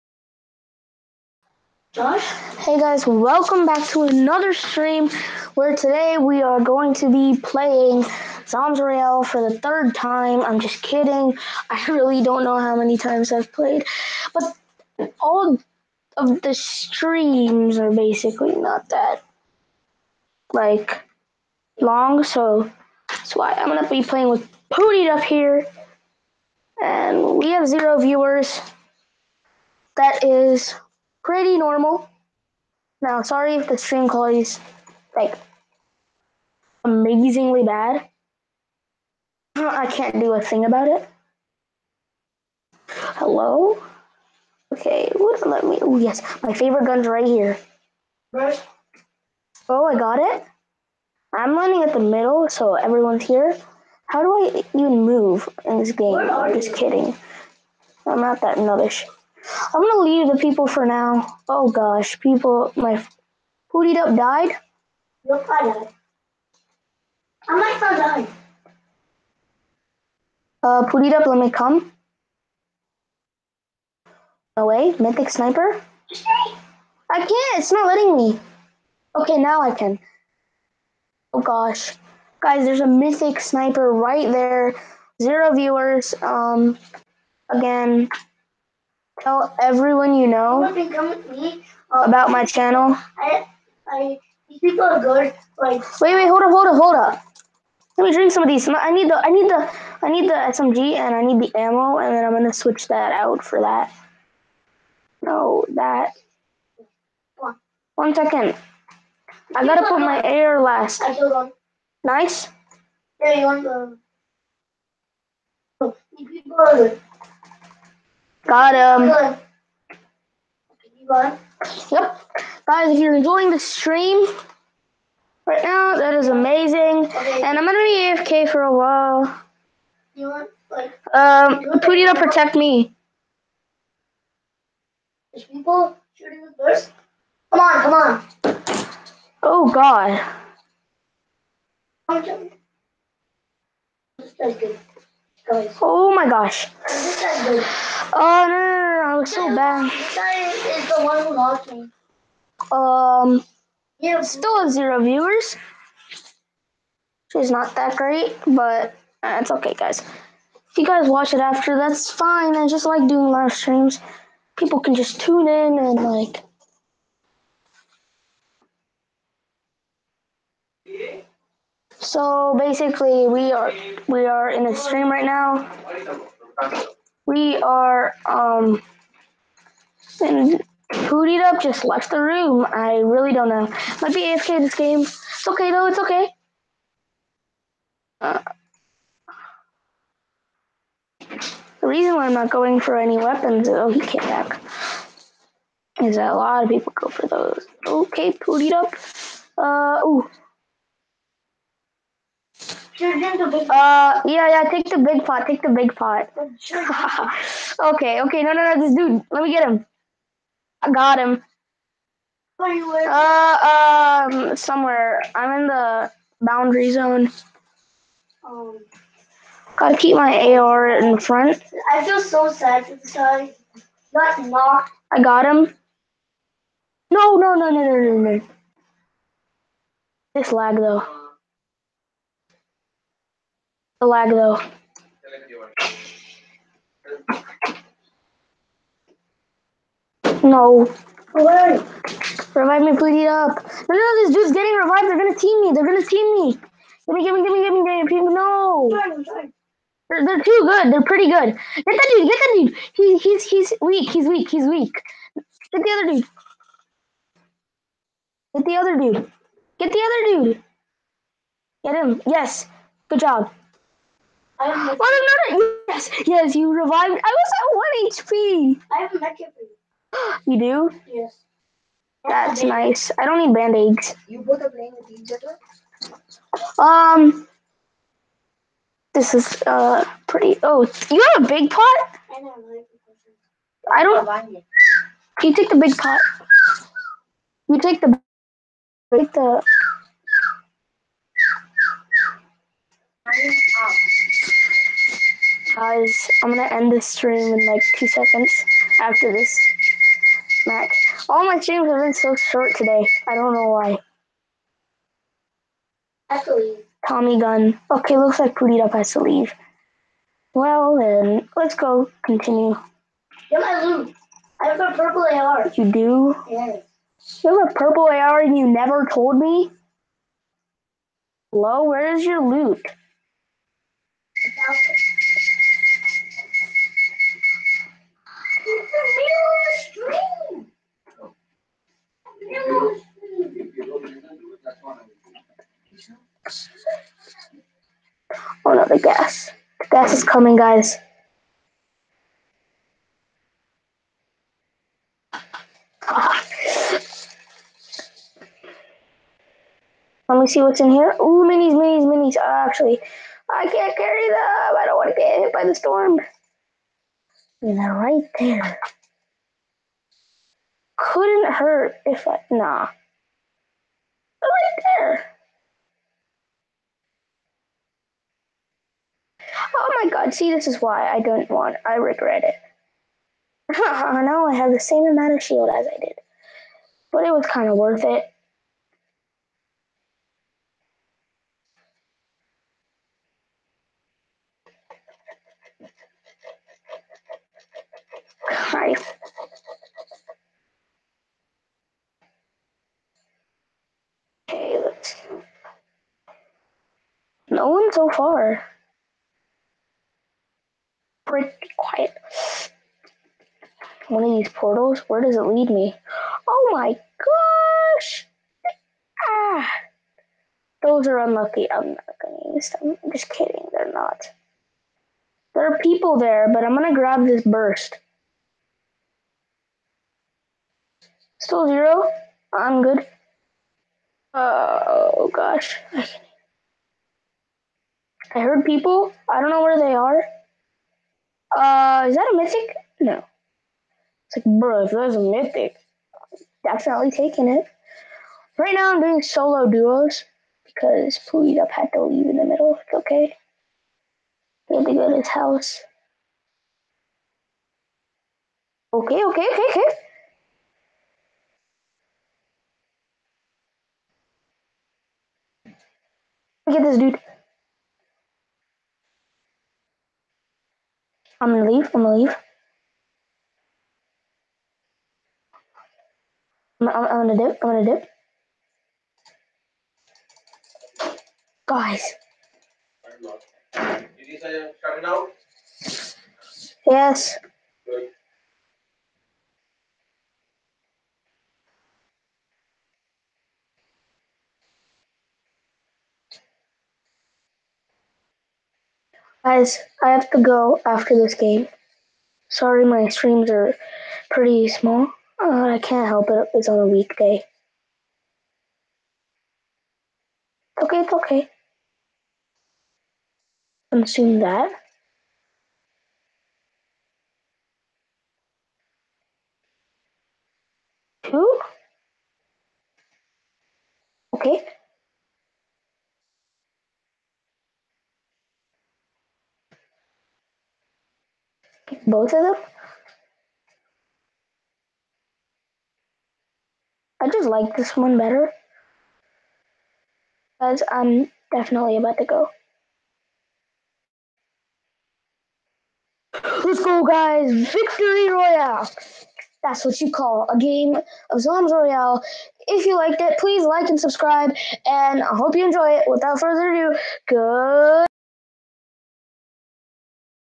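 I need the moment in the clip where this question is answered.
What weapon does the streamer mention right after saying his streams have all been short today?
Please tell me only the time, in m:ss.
5:07.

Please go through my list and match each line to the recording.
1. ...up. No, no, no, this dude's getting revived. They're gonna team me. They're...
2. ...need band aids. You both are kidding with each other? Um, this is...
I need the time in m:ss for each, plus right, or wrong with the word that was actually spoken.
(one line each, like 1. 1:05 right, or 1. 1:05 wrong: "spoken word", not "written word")
1. 4:03 right
2. 4:33 wrong: "playing", not "kidding".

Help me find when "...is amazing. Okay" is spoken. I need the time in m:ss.
2:06.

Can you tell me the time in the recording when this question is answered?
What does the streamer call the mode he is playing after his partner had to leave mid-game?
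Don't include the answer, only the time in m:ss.
7:19.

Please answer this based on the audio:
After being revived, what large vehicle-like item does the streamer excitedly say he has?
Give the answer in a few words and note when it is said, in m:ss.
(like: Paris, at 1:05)
a mech, at 4:29.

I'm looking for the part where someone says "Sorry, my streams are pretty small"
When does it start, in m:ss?
8:12.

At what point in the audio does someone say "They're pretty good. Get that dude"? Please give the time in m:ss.
4:10.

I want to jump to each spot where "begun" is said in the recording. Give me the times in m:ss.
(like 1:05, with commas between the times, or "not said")
not said.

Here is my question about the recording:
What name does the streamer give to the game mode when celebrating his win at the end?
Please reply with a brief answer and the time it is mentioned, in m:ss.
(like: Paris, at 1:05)
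Zombies Royale, at 9:01.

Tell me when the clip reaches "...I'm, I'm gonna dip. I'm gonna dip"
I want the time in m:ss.
7:46.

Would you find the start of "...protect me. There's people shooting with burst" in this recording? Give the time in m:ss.
2:11.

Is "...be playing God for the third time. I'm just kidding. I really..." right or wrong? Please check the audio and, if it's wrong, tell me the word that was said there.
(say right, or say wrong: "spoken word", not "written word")
wrong: "Royale", not "God".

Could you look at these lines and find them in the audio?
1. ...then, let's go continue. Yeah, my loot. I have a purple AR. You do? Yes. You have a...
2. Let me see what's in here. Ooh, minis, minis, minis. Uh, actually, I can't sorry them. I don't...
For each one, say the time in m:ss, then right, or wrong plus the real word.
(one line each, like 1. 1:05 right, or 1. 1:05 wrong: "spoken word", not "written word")
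1. 5:10 right
2. 5:50 wrong: "carry", not "sorry".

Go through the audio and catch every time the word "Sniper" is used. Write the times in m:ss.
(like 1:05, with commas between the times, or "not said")
1:15, 1:23.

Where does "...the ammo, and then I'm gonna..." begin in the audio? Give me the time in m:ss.
1:41.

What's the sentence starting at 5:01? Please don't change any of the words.
All my streams have been so short today.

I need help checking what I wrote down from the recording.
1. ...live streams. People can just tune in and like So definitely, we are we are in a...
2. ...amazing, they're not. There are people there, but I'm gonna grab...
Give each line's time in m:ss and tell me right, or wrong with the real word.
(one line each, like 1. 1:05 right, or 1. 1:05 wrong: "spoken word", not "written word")
1. 2:43 wrong: "basically", not "definitely"
2. 6:53 wrong: "kidding", not "amazing".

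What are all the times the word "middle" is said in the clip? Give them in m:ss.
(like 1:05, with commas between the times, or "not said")
0:51, 7:22.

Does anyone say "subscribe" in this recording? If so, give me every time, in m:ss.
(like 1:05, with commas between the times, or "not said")
9:03.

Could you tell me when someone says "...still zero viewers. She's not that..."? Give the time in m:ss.
2:34.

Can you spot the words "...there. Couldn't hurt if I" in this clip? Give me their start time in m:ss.
5:58.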